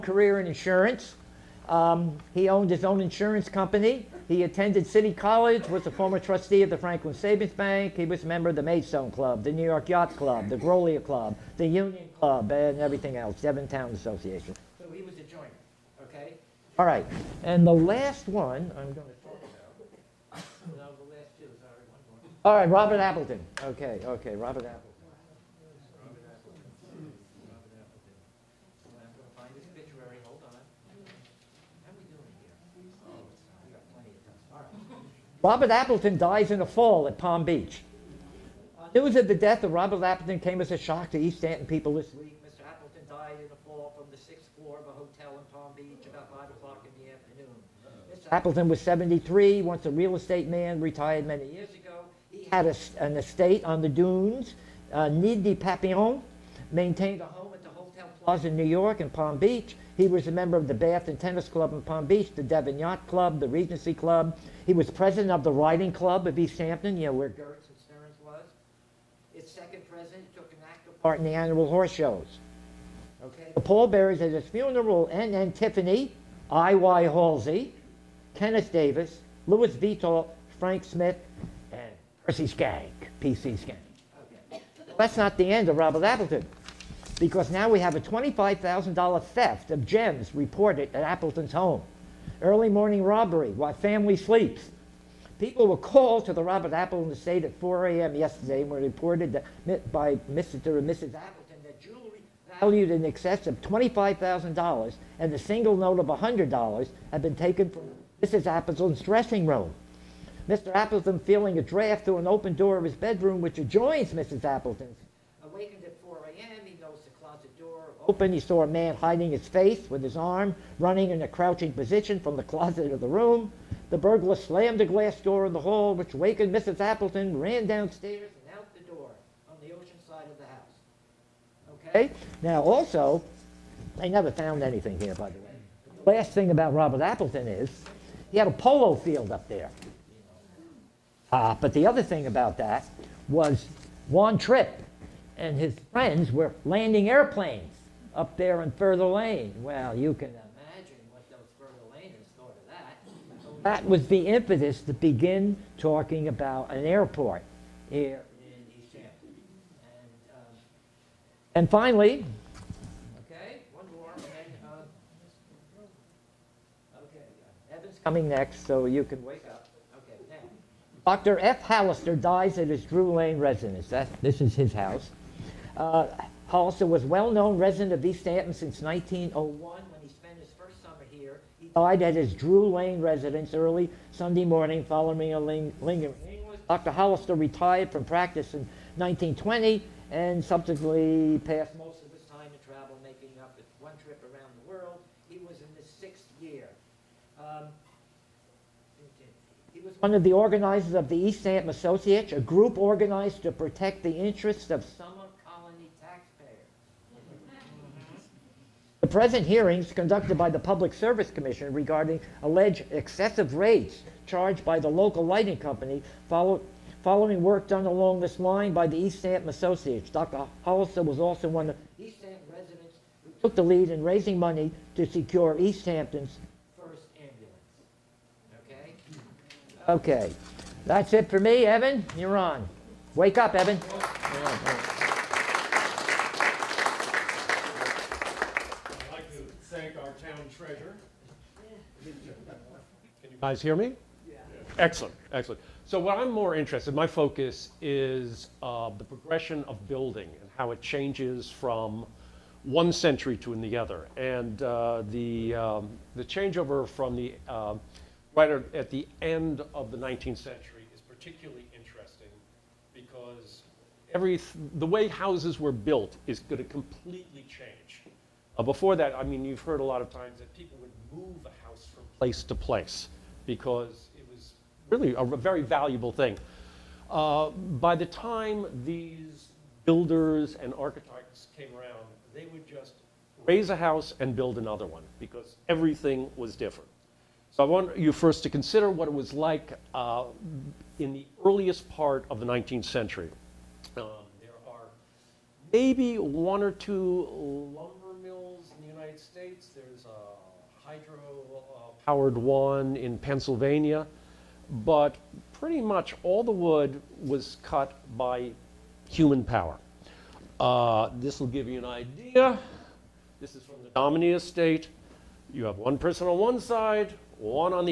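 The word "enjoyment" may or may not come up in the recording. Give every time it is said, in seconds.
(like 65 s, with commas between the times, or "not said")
not said.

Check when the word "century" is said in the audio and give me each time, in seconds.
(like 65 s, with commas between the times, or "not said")
252 s, 260 s, 292 s.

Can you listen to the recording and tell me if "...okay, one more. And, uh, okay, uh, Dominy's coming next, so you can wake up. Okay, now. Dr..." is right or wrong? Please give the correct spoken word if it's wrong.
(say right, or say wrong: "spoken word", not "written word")
wrong: "Evan", not "Dominy".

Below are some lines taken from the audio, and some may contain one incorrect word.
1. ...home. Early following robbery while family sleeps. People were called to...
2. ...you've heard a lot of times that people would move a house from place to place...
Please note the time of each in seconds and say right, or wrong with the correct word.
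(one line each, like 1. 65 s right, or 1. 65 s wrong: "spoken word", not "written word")
1. 91 s wrong: "morning", not "following"
2. 269 s right.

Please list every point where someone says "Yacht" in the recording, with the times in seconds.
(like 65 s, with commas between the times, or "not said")
9 s, 62 s.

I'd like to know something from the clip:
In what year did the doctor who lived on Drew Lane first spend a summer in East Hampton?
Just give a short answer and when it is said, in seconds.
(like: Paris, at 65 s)
1901, at 178 s.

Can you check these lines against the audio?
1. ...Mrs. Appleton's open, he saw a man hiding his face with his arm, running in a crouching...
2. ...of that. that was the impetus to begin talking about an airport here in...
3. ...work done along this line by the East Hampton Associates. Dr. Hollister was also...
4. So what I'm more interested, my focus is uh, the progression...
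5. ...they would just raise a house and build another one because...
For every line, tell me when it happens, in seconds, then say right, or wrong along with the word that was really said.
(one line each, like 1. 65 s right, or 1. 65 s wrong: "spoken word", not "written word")
1. 114 s right
2. 152 s right
3. 217 s right
4. 245 s right
5. 282 s right.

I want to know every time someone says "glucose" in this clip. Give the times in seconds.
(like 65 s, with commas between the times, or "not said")
not said.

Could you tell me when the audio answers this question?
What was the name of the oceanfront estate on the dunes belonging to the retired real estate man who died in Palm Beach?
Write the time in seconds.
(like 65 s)
55 s.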